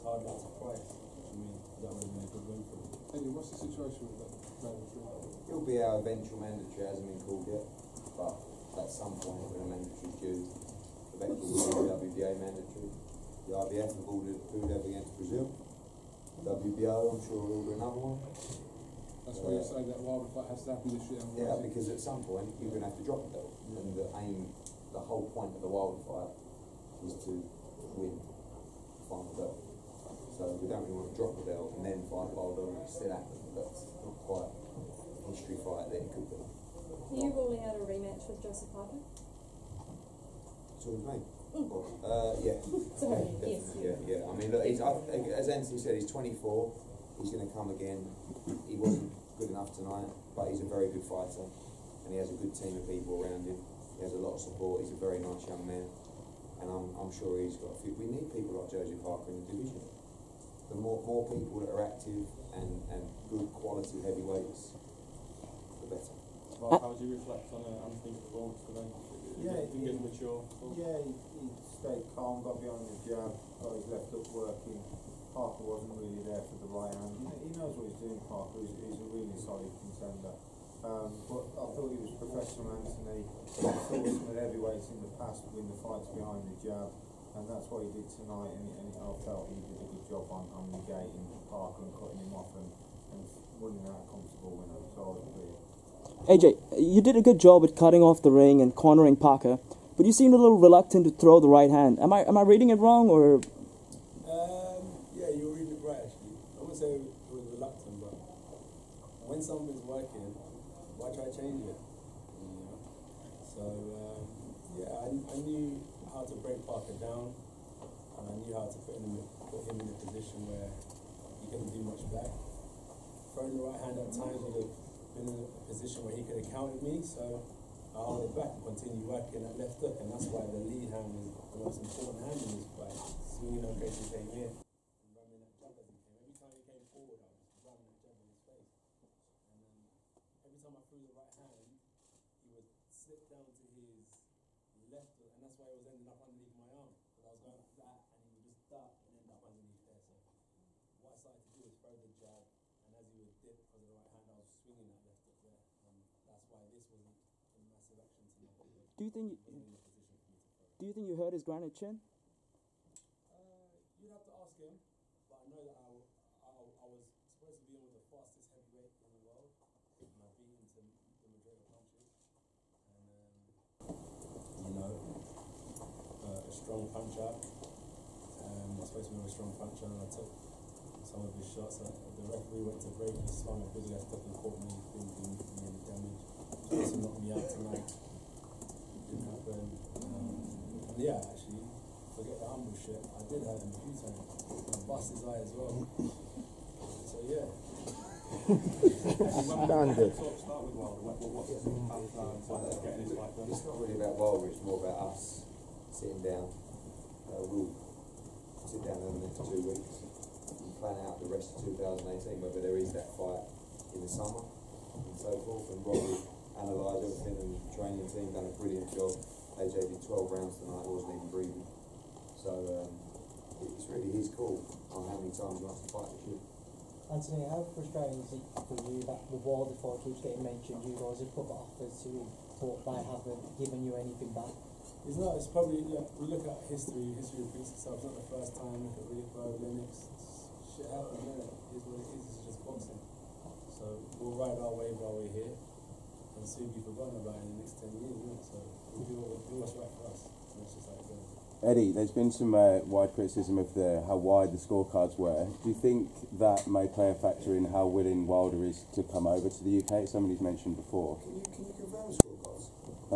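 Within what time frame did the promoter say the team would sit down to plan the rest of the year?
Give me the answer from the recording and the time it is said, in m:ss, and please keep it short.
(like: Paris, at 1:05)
2 weeks, at 3:29.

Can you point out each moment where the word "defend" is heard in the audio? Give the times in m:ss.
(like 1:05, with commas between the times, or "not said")
not said.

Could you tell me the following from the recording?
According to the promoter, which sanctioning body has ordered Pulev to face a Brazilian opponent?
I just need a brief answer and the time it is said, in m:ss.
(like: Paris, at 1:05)
IBF, at 0:13.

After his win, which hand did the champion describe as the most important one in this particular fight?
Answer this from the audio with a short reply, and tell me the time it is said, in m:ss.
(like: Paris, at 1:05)
The lead hand, at 2:10.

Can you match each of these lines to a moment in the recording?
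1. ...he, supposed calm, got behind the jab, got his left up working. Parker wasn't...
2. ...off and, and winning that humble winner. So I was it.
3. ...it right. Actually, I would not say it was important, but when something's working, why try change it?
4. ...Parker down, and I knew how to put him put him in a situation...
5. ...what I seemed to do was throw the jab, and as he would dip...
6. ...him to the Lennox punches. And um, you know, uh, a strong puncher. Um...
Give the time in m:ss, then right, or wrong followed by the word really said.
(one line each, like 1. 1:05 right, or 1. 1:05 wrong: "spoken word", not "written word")
1. 1:11 wrong: "stayed", not "supposed"
2. 1:32 wrong: "comfortable", not "humble"
3. 1:45 wrong: "reluctant", not "important"
4. 1:56 wrong: "position", not "situation"
5. 2:30 wrong: "started", not "seemed"
6. 2:50 wrong: "Madrid", not "Lennox".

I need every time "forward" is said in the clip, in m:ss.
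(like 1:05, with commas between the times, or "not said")
2:16.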